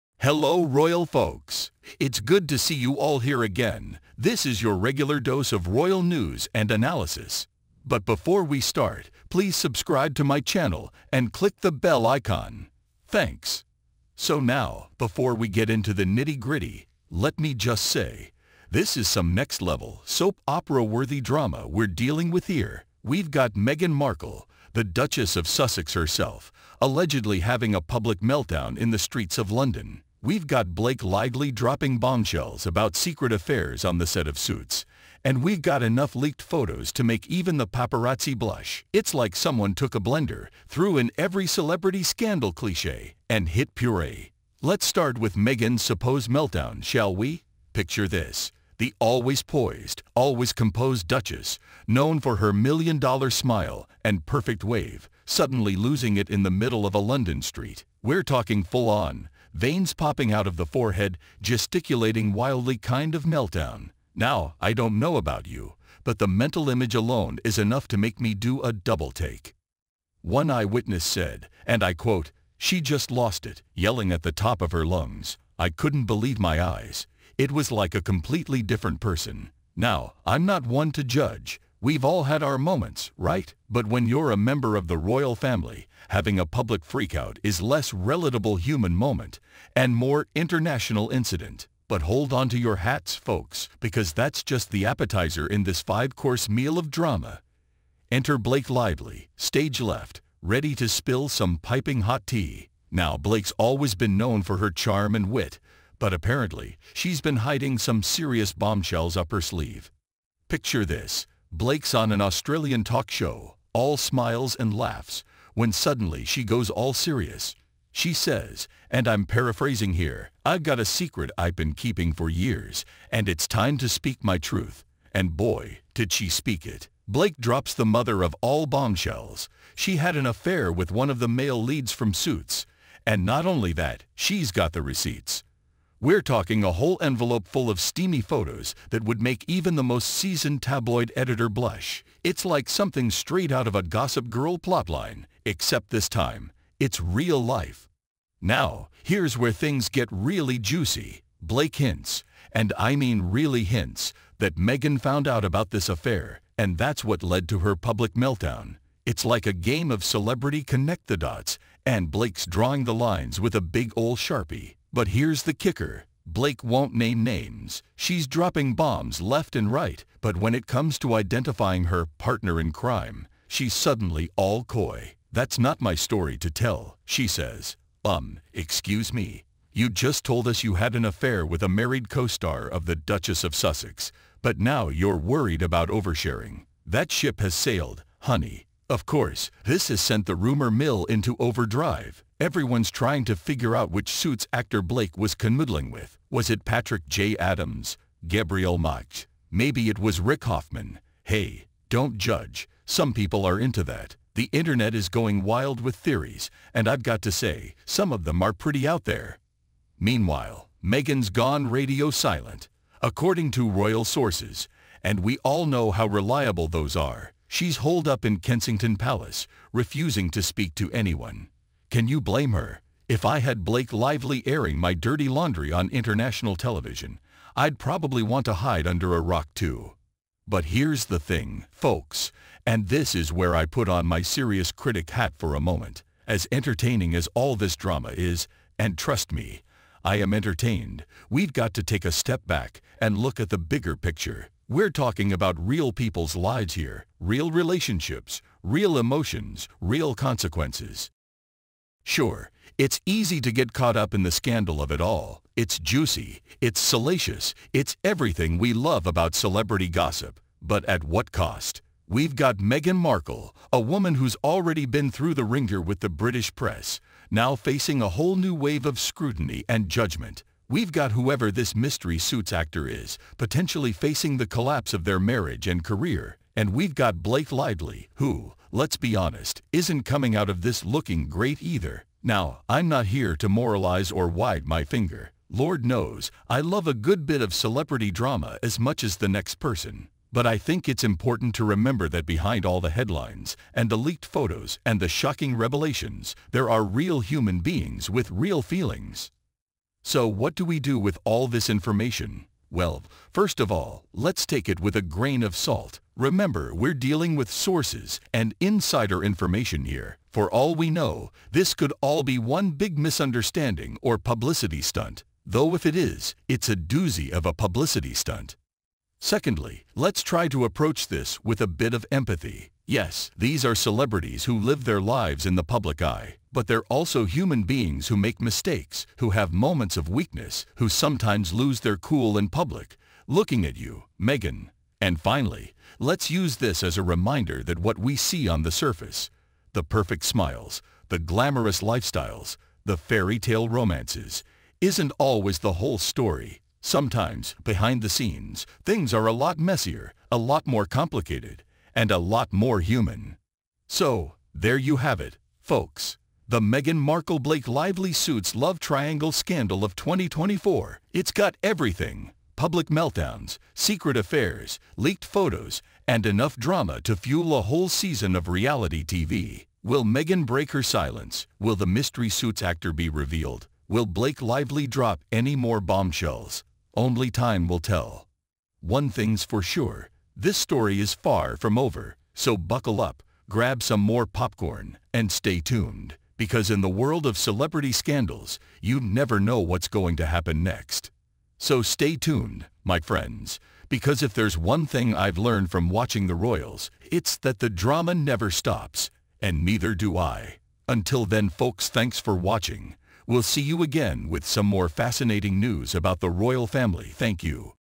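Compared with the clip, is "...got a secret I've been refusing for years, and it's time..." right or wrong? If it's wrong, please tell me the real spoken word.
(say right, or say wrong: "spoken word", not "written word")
wrong: "keeping", not "refusing".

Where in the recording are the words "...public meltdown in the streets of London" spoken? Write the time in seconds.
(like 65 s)
27 s.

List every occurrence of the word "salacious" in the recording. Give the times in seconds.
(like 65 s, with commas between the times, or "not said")
256 s.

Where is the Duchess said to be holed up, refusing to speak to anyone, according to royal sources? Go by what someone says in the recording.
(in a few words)
Kensington Palace.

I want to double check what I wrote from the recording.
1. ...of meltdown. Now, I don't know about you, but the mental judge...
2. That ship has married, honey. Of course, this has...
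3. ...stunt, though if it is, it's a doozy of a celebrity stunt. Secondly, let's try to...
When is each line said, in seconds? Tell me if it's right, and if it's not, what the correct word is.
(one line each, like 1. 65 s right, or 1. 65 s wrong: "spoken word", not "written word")
1. 63 s wrong: "image", not "judge"
2. 186 s wrong: "sailed", not "married"
3. 314 s wrong: "publicity", not "celebrity".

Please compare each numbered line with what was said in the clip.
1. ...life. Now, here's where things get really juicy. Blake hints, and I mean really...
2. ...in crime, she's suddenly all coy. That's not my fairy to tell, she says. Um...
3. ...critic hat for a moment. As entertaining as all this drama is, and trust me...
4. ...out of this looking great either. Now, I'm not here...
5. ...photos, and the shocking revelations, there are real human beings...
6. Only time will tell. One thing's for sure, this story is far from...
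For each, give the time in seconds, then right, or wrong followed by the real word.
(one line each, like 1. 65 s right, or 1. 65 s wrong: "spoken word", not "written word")
1. 147 s right
2. 172 s wrong: "story", not "fairy"
3. 234 s right
4. 280 s right
5. 294 s right
6. 376 s right.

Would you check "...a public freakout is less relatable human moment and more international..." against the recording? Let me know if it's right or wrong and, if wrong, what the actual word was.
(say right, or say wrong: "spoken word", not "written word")
right.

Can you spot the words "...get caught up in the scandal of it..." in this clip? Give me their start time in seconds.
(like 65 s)
253 s.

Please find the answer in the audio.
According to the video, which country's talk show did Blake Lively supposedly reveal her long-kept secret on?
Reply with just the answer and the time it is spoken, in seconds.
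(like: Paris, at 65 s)
Australian, at 112 s.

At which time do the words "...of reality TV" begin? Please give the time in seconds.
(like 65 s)
368 s.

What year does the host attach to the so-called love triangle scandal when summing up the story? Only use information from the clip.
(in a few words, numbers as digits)
2024.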